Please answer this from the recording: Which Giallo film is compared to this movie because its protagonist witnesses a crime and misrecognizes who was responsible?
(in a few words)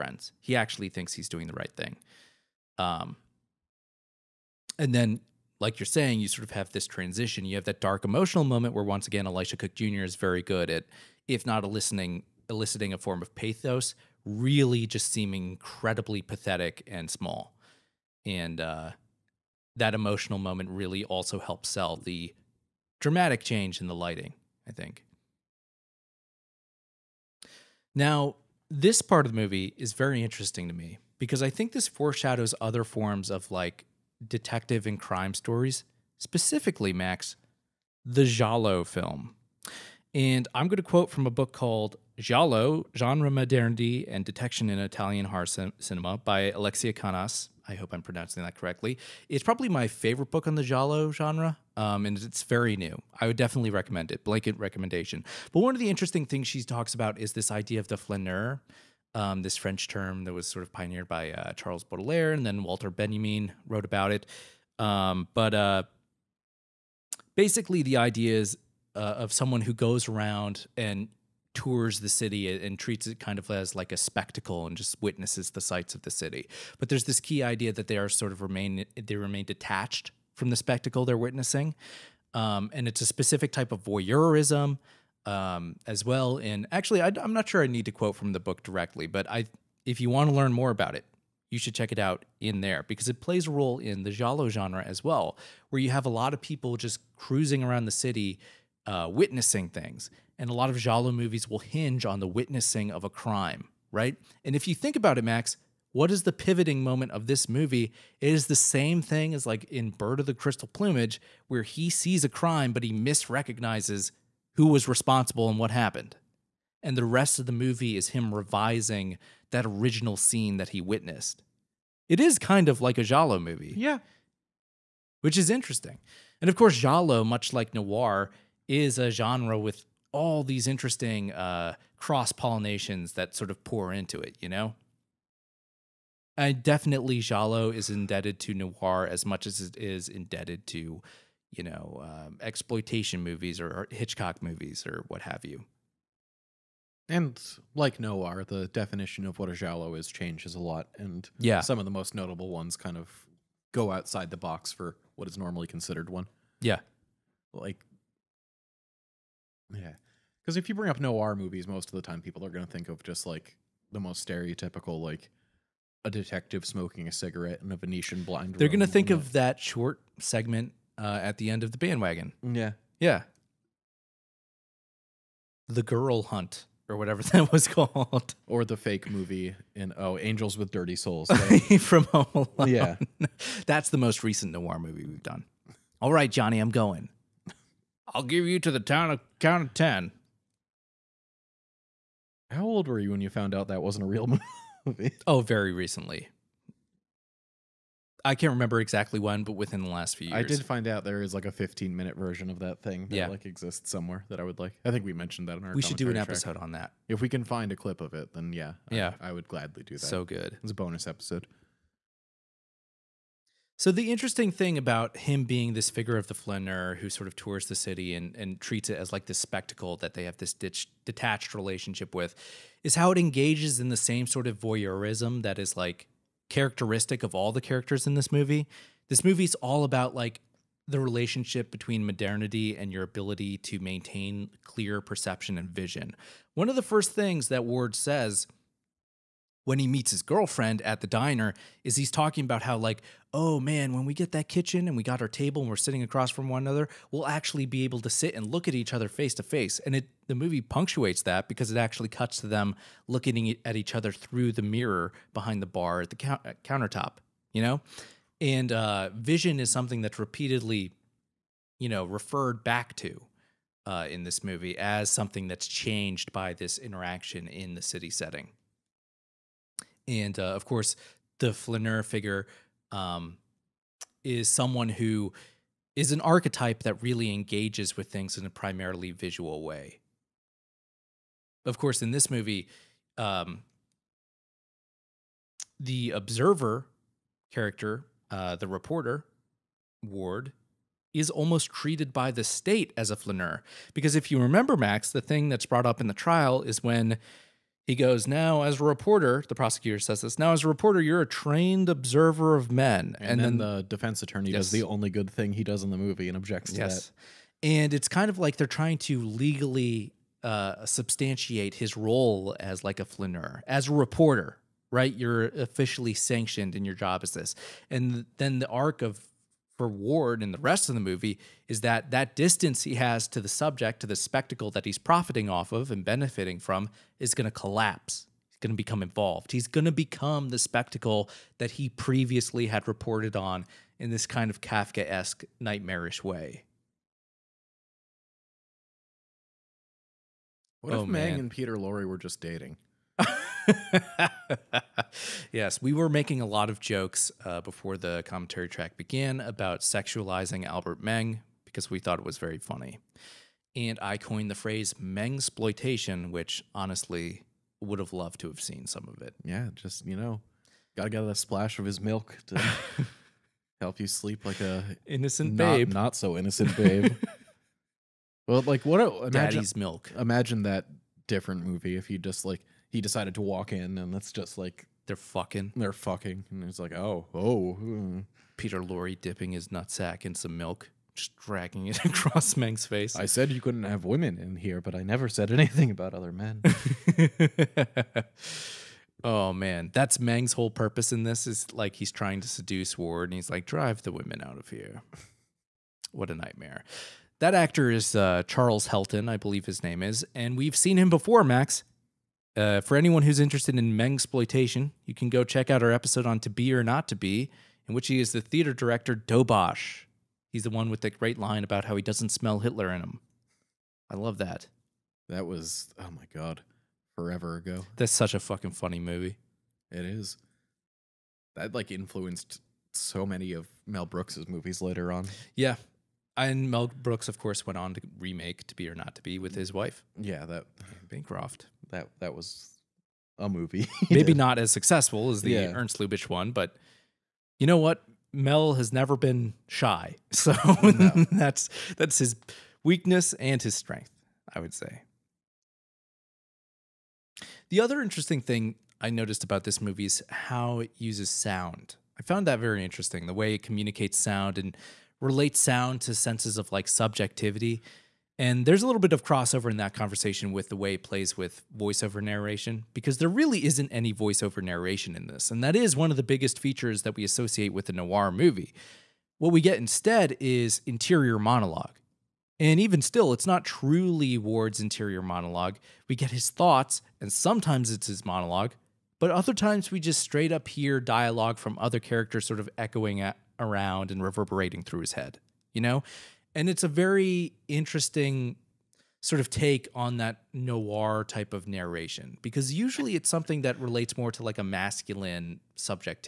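Bird of the Crystal Plumage.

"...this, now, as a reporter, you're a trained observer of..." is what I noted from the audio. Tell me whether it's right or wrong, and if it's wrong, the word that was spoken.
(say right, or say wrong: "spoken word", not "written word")
right.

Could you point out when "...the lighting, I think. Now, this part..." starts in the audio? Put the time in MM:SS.
00:23.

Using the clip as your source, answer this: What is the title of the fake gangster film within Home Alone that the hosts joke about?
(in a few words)
Angels with Dirty Souls.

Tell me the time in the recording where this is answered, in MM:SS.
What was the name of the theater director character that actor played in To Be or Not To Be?
06:49.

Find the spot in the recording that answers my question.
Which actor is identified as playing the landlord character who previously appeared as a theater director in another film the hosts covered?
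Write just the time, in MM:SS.
06:38.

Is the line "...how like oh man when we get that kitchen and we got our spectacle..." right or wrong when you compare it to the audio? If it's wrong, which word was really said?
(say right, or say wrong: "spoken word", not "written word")
wrong: "table", not "spectacle".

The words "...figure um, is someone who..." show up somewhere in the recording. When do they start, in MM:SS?
04:32.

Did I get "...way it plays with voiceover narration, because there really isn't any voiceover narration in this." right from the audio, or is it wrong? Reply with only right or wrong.
right.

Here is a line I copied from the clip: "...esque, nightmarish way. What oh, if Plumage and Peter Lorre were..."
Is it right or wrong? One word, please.
wrong.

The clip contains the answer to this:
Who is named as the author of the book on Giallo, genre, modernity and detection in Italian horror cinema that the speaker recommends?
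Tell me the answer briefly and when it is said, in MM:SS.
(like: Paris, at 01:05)
Alexia Kannas, at 00:46.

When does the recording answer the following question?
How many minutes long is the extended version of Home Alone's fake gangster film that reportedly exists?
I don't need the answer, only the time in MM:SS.
03:21.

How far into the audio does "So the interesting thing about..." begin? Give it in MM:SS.
03:33.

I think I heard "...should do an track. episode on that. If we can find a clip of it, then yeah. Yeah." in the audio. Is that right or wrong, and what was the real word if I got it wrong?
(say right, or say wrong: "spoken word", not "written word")
right.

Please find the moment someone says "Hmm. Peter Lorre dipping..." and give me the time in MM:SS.
06:17.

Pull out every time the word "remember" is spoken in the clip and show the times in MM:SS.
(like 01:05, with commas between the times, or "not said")
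03:18, 04:54.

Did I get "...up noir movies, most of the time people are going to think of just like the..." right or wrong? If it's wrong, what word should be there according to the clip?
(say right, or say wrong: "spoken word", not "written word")
right.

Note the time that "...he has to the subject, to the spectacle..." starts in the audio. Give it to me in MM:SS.
05:22.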